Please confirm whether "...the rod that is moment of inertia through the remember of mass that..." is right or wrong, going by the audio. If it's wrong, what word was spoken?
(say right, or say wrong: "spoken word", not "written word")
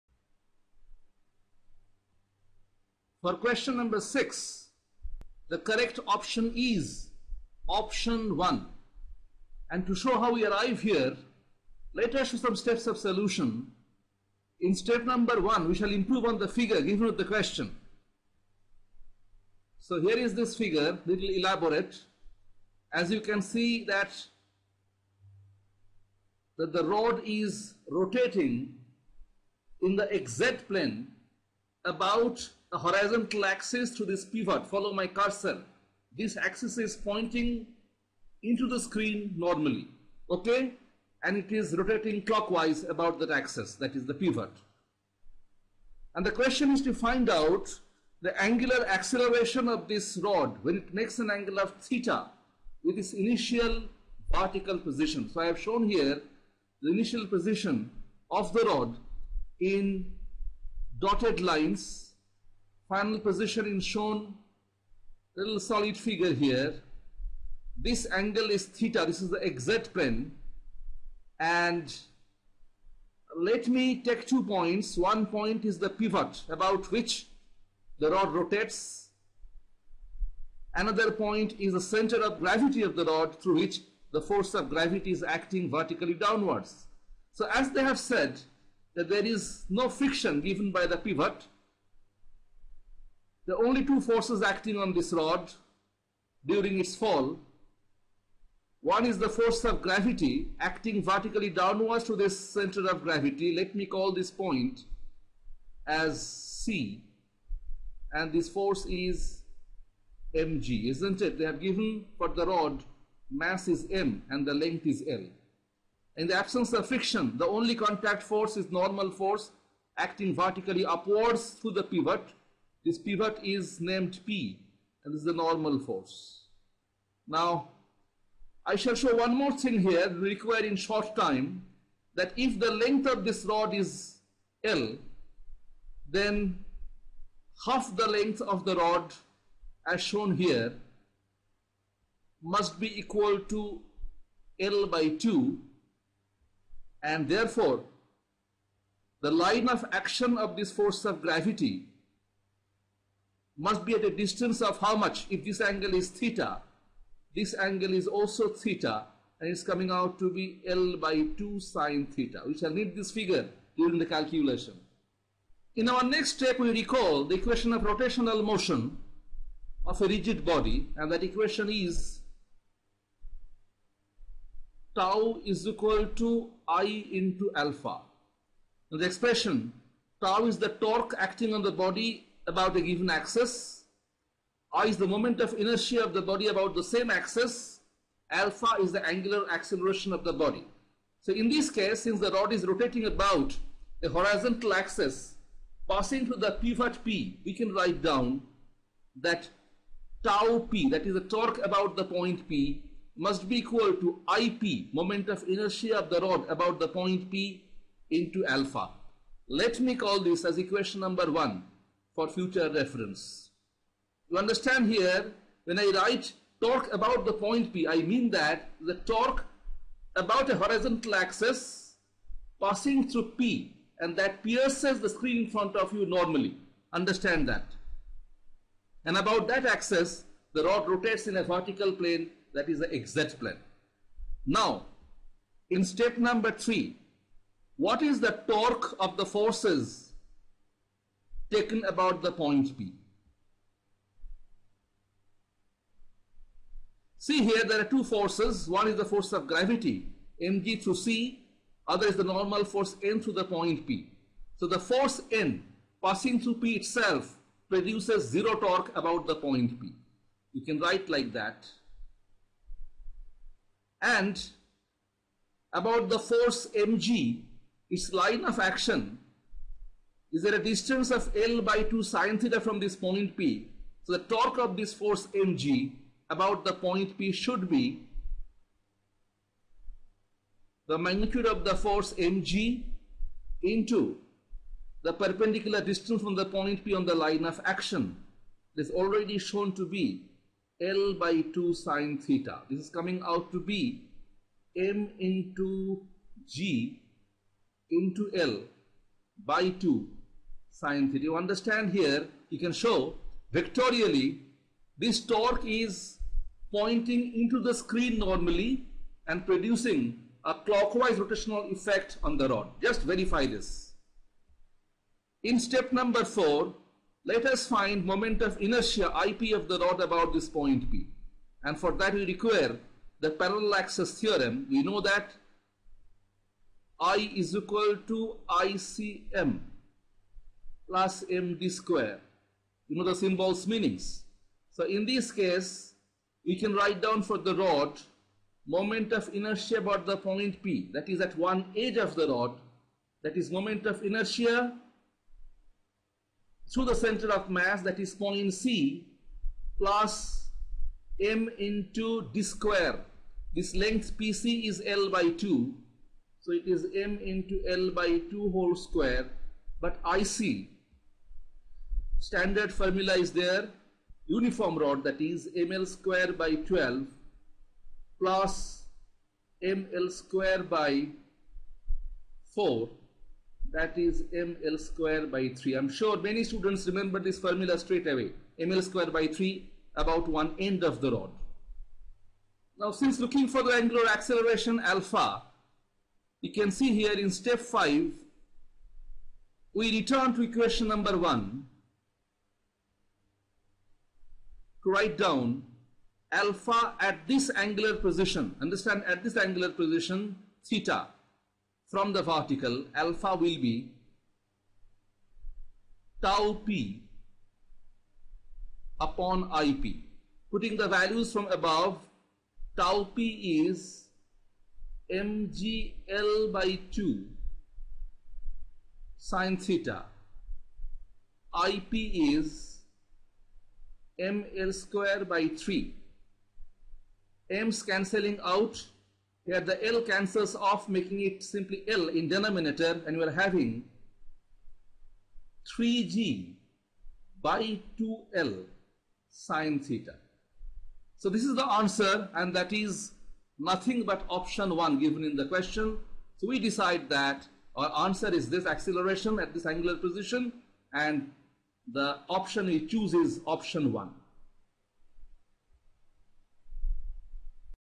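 wrong: "center", not "remember".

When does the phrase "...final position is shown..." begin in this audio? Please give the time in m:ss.
1:02.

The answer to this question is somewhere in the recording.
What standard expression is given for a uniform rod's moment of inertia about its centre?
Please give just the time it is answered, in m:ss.
6:05.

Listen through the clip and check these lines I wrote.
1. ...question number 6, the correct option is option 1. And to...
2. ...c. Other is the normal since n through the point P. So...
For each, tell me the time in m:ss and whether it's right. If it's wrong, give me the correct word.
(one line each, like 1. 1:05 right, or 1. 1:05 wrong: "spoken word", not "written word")
1. 0:03 right
2. 4:10 wrong: "force", not "since".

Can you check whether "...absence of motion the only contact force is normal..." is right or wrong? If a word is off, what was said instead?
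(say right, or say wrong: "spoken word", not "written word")
wrong: "friction", not "motion".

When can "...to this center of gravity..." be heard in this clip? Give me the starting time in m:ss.
1:42.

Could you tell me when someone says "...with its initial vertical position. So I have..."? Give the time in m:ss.
0:52.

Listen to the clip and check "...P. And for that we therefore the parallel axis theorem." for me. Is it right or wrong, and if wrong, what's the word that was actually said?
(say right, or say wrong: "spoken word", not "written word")
wrong: "require", not "therefore".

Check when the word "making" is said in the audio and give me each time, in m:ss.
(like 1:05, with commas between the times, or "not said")
7:10.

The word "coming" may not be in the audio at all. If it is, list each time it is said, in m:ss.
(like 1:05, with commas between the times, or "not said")
2:39, 4:52.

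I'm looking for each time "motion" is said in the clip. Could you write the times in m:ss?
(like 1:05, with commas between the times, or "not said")
2:48.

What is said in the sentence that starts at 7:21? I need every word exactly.
So this is the answer and that is nothing but option 1 given in the question.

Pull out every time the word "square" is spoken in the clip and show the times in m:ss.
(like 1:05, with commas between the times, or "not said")
5:31, 5:52, 5:58, 6:05, 6:10, 6:14, 6:18, 7:04.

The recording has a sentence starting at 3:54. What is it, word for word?
Now, in step number 3, what is the torque of the forces taken about the point P.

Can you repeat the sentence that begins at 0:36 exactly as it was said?
This axis is pointing into the screen normally, okay?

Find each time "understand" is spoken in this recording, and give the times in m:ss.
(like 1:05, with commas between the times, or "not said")
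3:34, 3:46, 5:01, 6:38.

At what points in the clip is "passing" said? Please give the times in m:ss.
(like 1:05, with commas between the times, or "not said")
3:15, 3:42, 4:16.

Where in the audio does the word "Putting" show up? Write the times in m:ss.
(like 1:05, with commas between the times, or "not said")
6:50.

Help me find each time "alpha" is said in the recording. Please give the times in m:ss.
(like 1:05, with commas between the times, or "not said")
2:57, 3:08, 3:28, 6:24, 6:36, 6:43.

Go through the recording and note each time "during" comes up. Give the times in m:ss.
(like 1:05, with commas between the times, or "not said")
1:36, 2:43.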